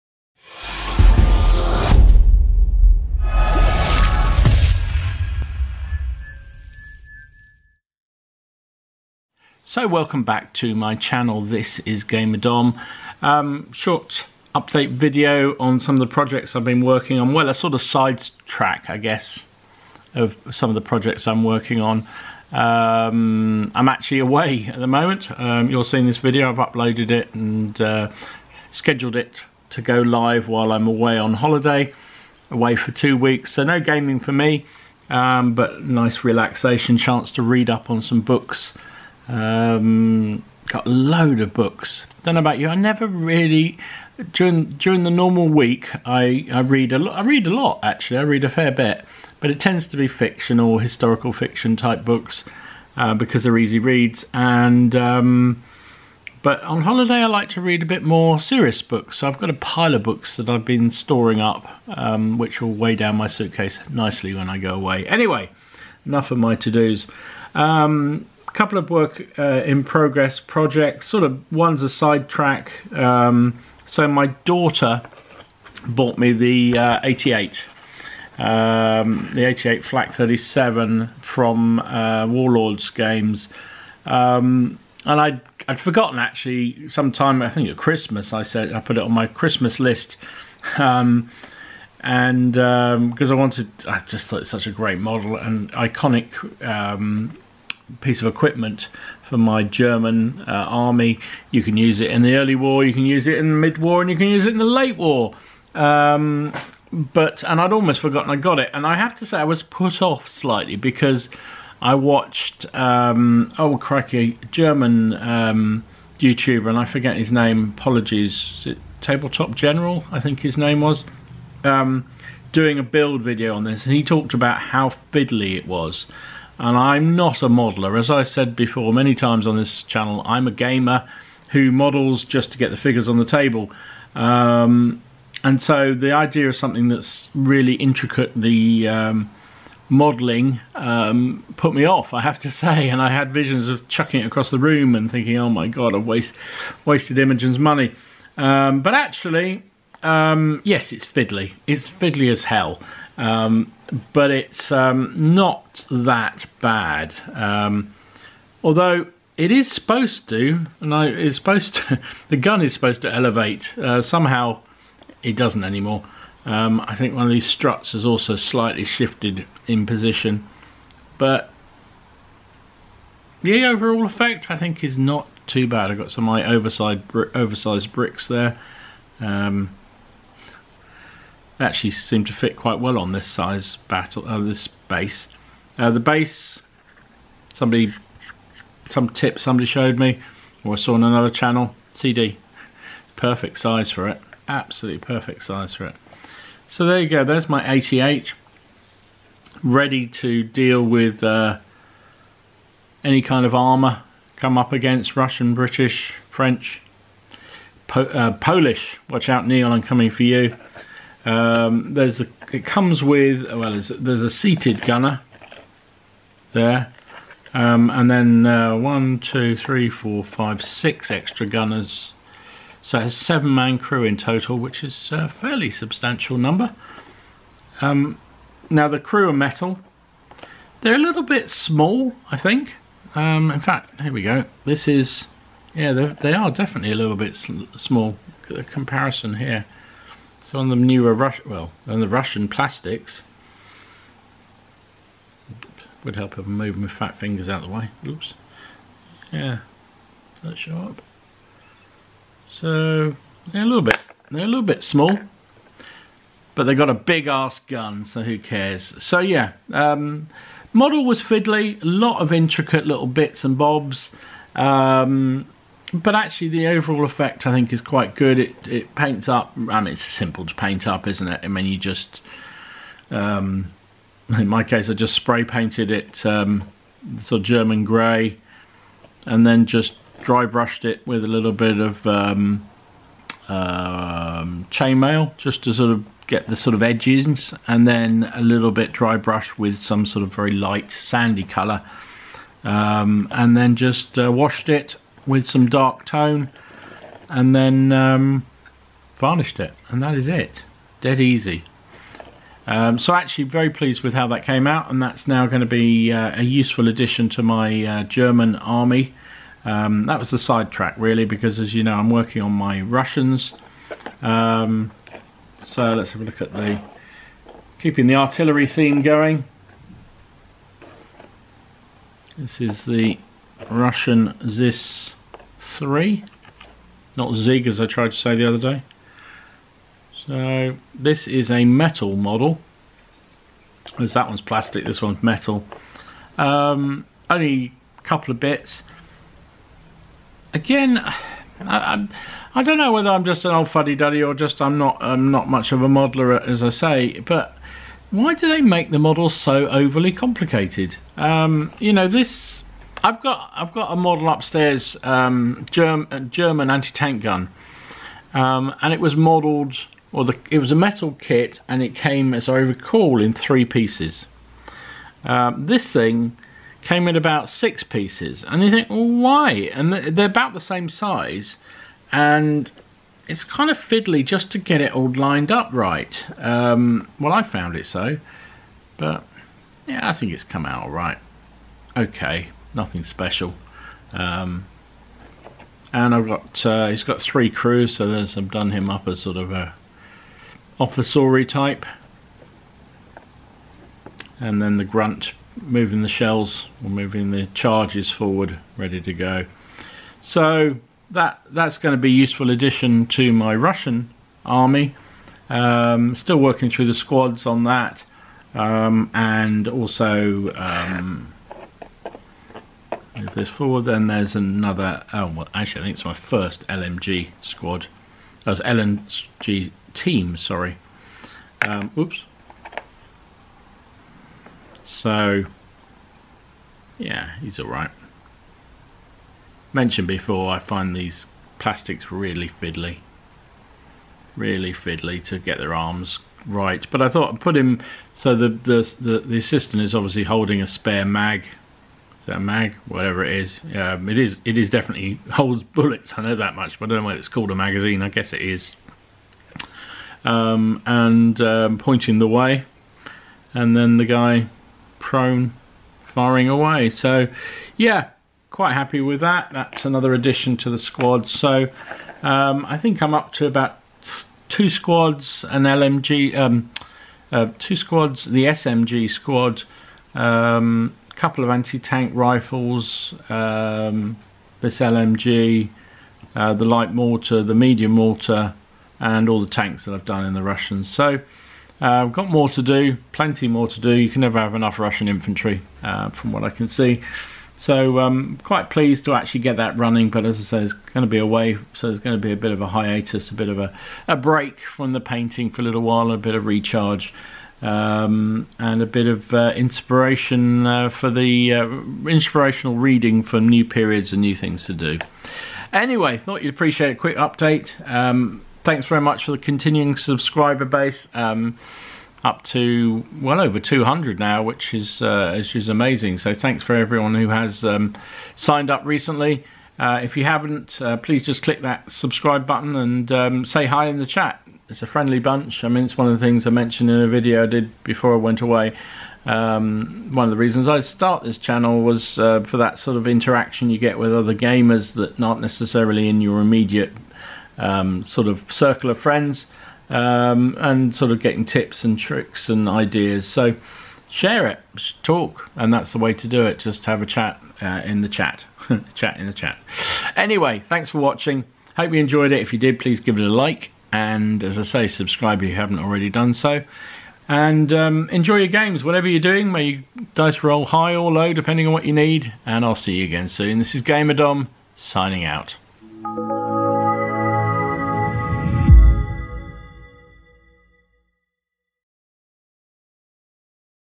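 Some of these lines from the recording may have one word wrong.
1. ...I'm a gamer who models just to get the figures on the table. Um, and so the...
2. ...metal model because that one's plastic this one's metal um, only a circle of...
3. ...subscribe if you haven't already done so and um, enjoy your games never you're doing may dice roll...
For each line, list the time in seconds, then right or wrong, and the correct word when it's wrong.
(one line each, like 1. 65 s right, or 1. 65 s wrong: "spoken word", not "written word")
1. 130 s right
2. 331 s wrong: "couple", not "circle"
3. 554 s wrong: "whatever", not "never".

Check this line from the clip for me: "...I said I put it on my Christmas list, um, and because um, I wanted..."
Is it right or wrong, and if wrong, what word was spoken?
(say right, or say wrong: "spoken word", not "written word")
right.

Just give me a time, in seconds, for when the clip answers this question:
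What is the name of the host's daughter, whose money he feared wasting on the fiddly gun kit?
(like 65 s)
147 s.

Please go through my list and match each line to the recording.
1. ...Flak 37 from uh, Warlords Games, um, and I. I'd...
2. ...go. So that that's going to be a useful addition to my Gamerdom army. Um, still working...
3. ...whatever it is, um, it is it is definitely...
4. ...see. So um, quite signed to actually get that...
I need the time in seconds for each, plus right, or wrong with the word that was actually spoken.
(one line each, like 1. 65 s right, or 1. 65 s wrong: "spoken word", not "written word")
1. 79 s right
2. 399 s wrong: "Russian", not "Gamerdom"
3. 442 s right
4. 486 s wrong: "pleased", not "signed".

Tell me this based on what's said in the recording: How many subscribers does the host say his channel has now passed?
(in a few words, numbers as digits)
200.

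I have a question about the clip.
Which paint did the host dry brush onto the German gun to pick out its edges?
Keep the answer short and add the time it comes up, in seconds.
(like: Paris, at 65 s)
Chainmail, at 284 s.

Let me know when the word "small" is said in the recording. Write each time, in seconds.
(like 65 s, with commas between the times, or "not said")
231 s, 237 s, 254 s.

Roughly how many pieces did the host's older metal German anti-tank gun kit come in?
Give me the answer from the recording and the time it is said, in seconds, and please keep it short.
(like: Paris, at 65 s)
3, at 363 s.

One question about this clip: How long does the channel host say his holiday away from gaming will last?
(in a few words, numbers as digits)
2 weeks.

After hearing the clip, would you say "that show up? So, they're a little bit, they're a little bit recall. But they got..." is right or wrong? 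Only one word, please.
wrong.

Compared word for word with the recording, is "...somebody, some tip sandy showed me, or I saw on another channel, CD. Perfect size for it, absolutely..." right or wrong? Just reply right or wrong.
wrong.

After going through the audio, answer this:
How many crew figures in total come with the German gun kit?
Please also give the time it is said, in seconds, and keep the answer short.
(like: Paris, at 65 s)
7, at 223 s.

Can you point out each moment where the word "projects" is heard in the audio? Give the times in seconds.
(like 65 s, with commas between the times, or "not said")
16 s, 20 s, 70 s.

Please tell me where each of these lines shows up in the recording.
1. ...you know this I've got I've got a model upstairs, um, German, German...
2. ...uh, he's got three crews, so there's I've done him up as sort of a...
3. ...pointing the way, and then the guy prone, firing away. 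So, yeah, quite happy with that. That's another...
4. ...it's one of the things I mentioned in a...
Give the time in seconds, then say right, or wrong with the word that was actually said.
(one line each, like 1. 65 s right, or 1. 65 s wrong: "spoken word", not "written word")
1. 351 s right
2. 386 s right
3. 451 s right
4. 525 s right.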